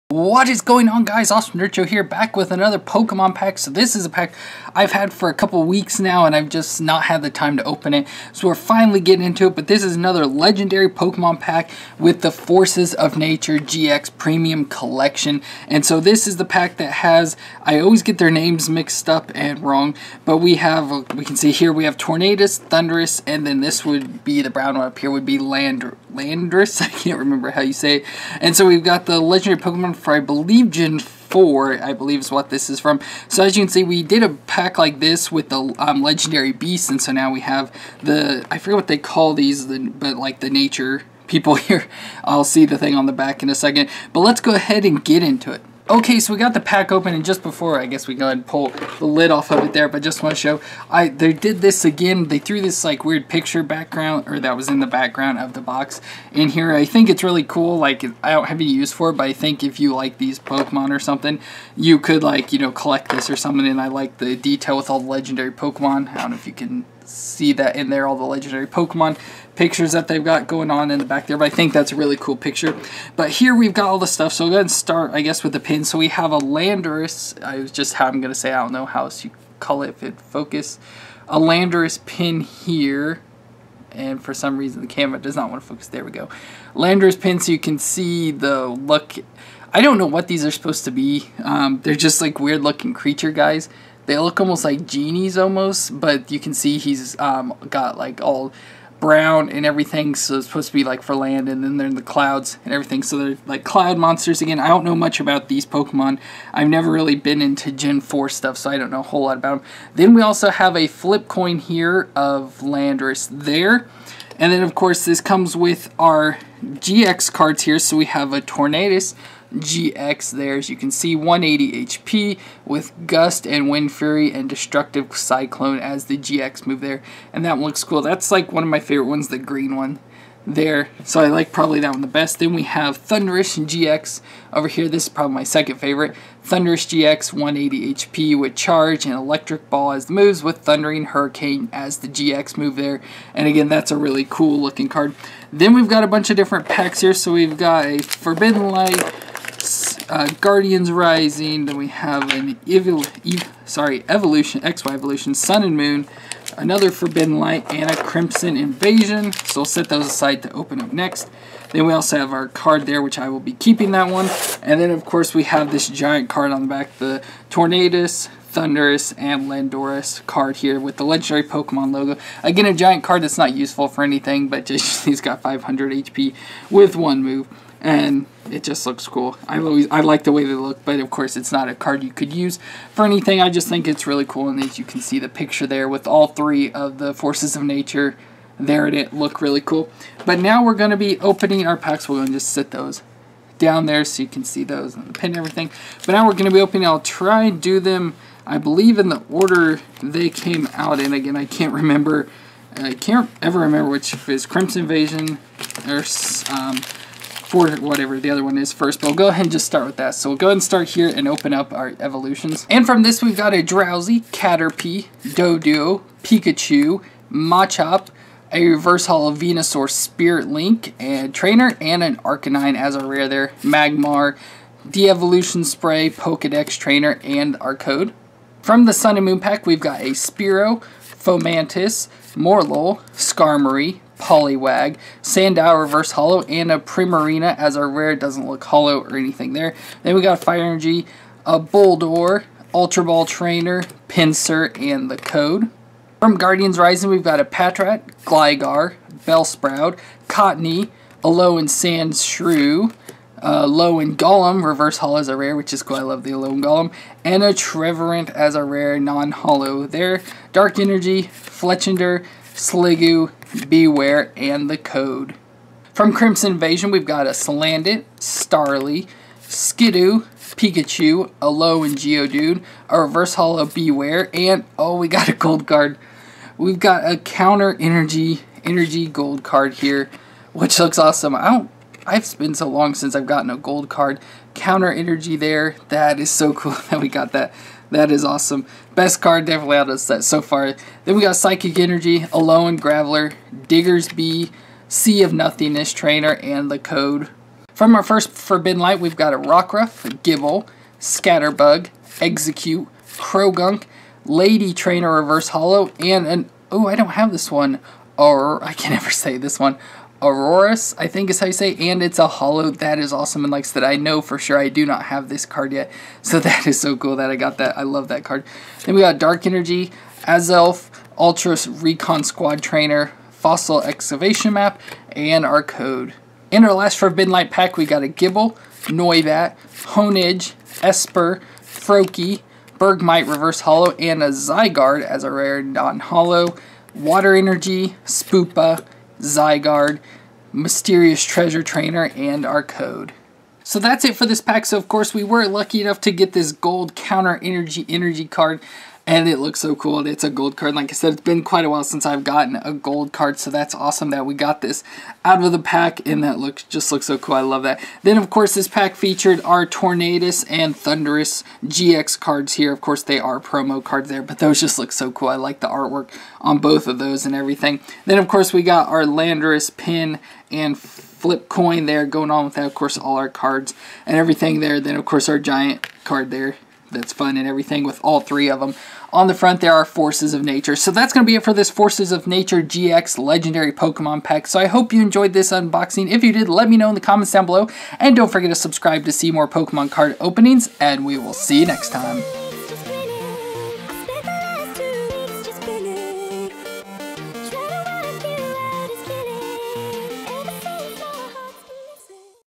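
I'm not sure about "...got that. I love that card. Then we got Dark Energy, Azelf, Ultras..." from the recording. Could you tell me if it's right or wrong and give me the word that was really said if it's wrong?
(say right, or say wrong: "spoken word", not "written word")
right.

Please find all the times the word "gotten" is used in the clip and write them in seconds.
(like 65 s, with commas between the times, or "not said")
283 s, 352 s.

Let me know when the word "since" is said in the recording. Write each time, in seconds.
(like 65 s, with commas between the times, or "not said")
282 s, 351 s.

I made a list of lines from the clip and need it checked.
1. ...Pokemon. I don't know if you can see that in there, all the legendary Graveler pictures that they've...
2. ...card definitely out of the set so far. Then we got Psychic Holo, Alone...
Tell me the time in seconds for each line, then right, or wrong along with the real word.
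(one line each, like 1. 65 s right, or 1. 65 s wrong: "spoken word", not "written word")
1. 65 s wrong: "Pokemon", not "Graveler"
2. 289 s wrong: "Energy", not "Holo".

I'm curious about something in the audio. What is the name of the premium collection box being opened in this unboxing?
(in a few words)
Forces of Nature GX Premium Collection.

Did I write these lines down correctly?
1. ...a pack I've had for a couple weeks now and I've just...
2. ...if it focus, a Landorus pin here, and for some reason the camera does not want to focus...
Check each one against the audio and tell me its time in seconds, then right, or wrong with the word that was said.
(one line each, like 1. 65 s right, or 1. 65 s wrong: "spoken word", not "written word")
1. 4 s right
2. 79 s right.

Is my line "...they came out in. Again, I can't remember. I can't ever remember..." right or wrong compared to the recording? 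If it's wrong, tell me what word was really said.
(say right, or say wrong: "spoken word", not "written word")
right.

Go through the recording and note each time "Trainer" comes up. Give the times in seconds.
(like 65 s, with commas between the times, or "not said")
221 s, 226 s, 243 s, 295 s, 304 s, 322 s, 341 s.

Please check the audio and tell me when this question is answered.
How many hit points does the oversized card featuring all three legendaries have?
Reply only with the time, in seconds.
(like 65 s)
175 s.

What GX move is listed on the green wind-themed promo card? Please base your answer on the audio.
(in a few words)
Destructive Cyclone.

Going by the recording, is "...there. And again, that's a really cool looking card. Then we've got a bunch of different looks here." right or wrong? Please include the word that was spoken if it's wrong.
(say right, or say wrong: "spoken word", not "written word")
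wrong: "packs", not "looks".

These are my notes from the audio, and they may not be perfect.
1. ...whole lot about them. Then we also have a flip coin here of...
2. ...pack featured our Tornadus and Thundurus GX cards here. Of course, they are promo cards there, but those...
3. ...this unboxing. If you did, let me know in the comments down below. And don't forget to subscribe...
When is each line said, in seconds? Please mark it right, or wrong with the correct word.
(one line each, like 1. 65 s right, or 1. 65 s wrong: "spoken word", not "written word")
1. 109 s right
2. 358 s right
3. 385 s right.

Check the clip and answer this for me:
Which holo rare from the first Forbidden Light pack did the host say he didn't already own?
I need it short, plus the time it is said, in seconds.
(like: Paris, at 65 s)
Aurorus, at 310 s.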